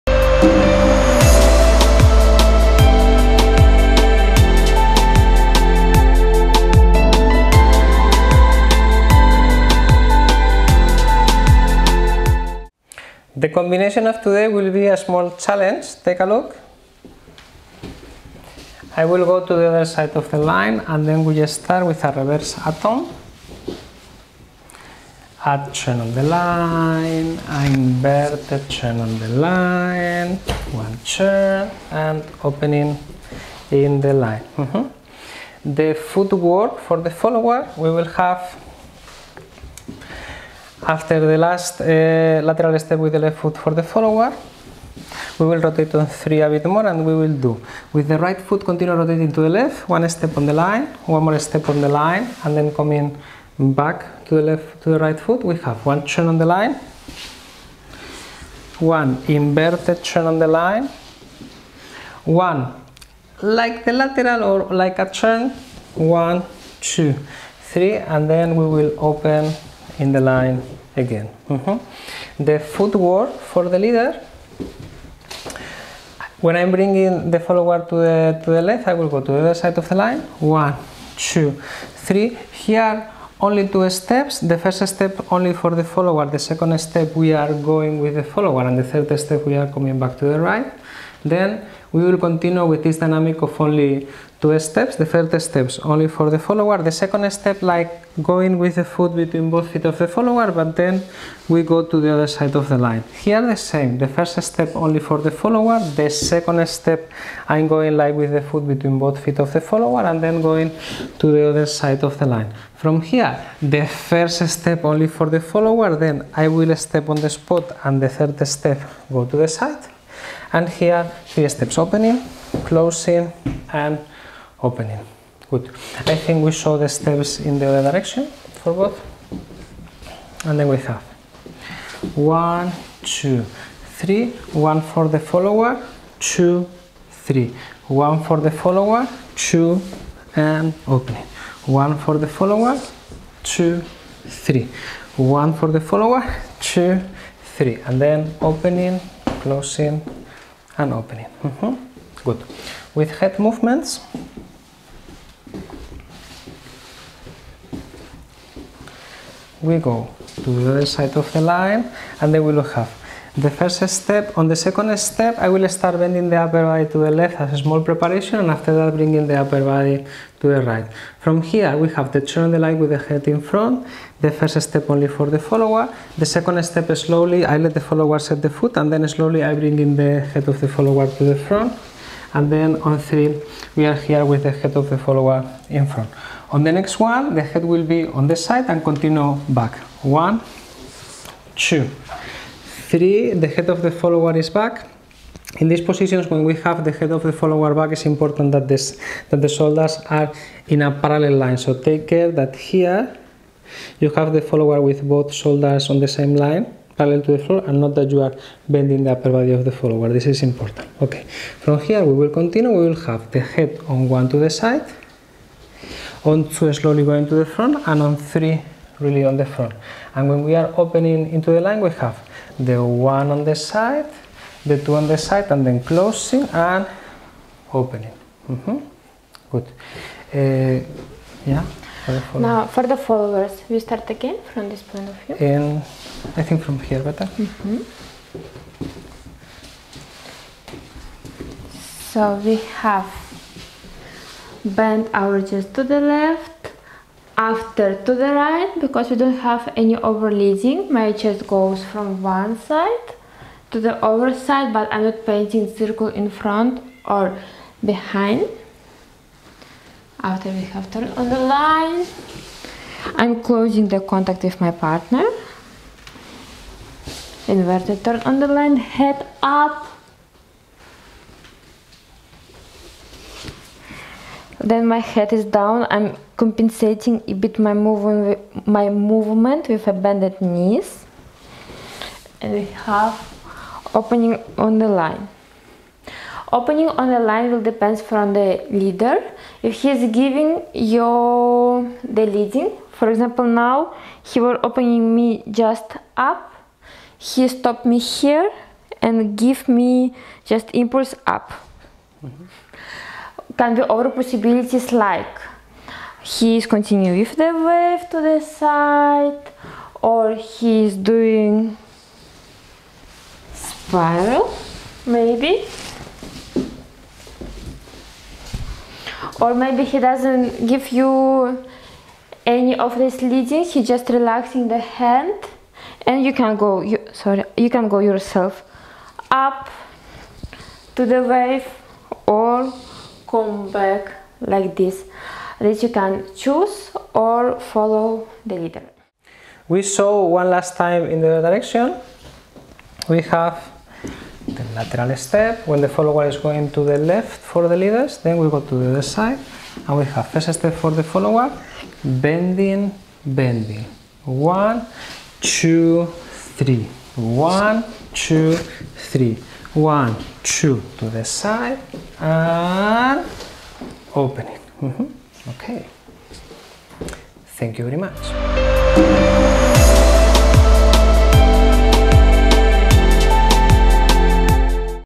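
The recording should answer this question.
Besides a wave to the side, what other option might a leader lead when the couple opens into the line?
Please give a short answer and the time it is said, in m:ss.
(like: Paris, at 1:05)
spiral, at 5:13.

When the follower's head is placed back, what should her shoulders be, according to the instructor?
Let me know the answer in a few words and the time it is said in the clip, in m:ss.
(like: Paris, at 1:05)
in a parallel line, at 3:20.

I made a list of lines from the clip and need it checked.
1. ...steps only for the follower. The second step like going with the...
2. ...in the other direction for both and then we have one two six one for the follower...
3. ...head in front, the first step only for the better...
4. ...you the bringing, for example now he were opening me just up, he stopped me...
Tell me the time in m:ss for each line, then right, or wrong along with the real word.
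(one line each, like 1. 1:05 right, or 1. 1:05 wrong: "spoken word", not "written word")
1. 1:35 right
2. 2:07 wrong: "three", not "six"
3. 2:52 wrong: "follower", not "better"
4. 4:50 wrong: "leading", not "bringing".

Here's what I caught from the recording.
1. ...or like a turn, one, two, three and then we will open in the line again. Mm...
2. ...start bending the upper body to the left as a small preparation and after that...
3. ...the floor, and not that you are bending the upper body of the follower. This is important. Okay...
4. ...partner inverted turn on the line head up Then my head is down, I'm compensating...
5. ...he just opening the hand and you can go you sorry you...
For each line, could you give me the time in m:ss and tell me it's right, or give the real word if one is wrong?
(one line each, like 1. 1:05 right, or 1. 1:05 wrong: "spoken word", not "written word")
1. 1:04 right
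2. 2:45 right
3. 3:27 right
4. 4:24 right
5. 5:23 wrong: "relaxing", not "opening".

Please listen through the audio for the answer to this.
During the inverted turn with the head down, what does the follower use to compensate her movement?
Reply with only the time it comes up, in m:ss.
4:39.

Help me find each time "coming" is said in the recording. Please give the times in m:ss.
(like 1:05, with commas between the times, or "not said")
0:52, 1:29.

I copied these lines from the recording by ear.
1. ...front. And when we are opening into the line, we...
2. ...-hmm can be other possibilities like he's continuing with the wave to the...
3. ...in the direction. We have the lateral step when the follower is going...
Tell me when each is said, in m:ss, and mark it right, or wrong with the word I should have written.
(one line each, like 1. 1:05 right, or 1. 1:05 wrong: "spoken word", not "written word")
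1. 3:39 right
2. 5:02 right
3. 5:41 right.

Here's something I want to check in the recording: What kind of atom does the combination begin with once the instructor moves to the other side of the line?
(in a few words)
reverse atom.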